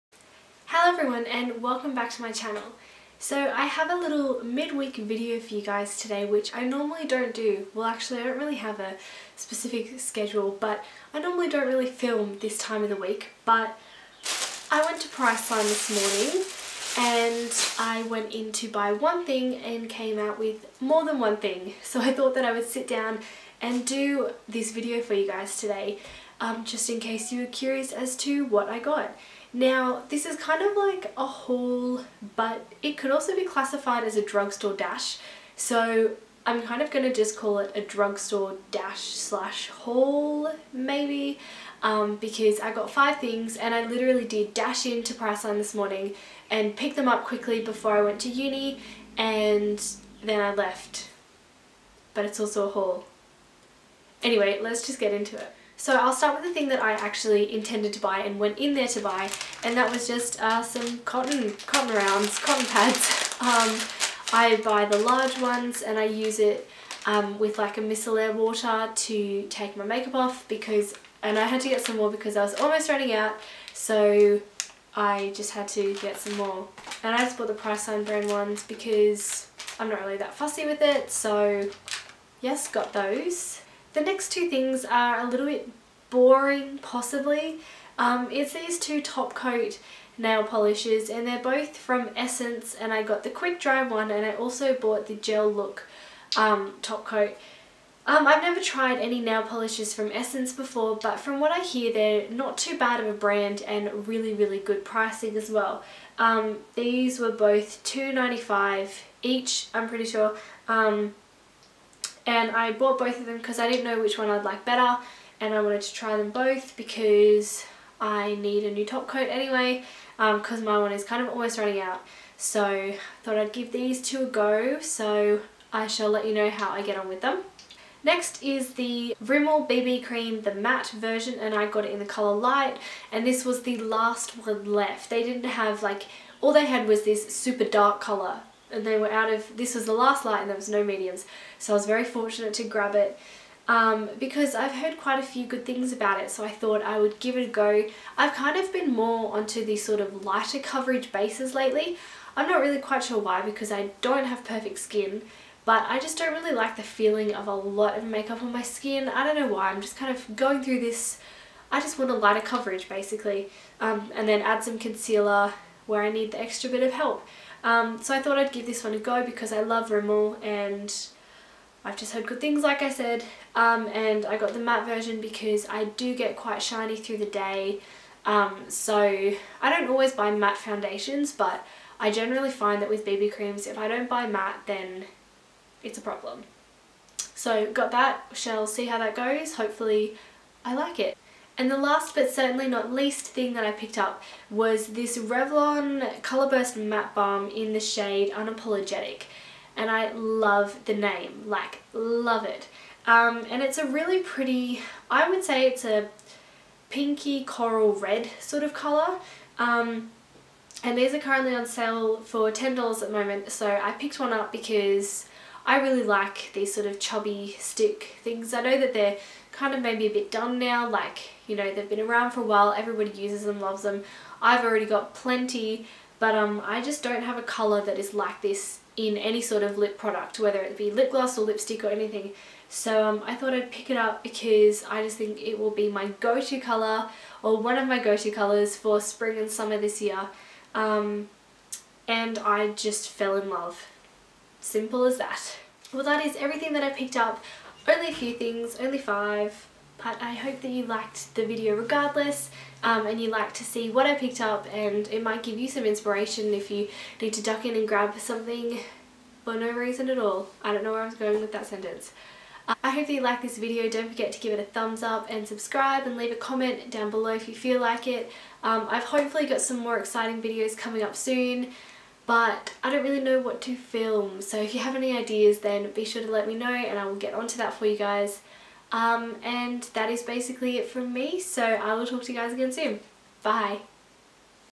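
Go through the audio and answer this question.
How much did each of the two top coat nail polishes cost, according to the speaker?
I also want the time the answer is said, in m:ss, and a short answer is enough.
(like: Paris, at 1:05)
$2.95, at 1:47.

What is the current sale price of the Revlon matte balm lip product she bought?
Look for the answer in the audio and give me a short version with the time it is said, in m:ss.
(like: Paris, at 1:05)
$10, at 3:32.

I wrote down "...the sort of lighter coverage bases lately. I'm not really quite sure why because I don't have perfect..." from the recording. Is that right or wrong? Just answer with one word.
right.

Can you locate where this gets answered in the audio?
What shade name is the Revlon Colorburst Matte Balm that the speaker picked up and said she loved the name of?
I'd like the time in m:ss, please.
3:18.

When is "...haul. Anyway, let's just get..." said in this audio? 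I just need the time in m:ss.
0:52.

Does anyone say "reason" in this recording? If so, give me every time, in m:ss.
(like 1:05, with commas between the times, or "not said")
4:19.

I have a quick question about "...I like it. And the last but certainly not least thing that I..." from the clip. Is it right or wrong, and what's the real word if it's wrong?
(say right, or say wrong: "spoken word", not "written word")
right.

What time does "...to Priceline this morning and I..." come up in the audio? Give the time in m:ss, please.
0:15.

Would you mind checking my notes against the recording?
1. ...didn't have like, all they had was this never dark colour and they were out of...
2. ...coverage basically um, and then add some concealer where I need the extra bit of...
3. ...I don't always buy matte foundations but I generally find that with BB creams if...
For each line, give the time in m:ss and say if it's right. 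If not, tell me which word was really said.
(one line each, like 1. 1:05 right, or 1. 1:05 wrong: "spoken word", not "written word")
1. 2:15 wrong: "super", not "never"
2. 2:42 right
3. 2:58 right.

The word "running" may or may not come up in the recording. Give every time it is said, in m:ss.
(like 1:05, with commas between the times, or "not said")
1:12, 2:01.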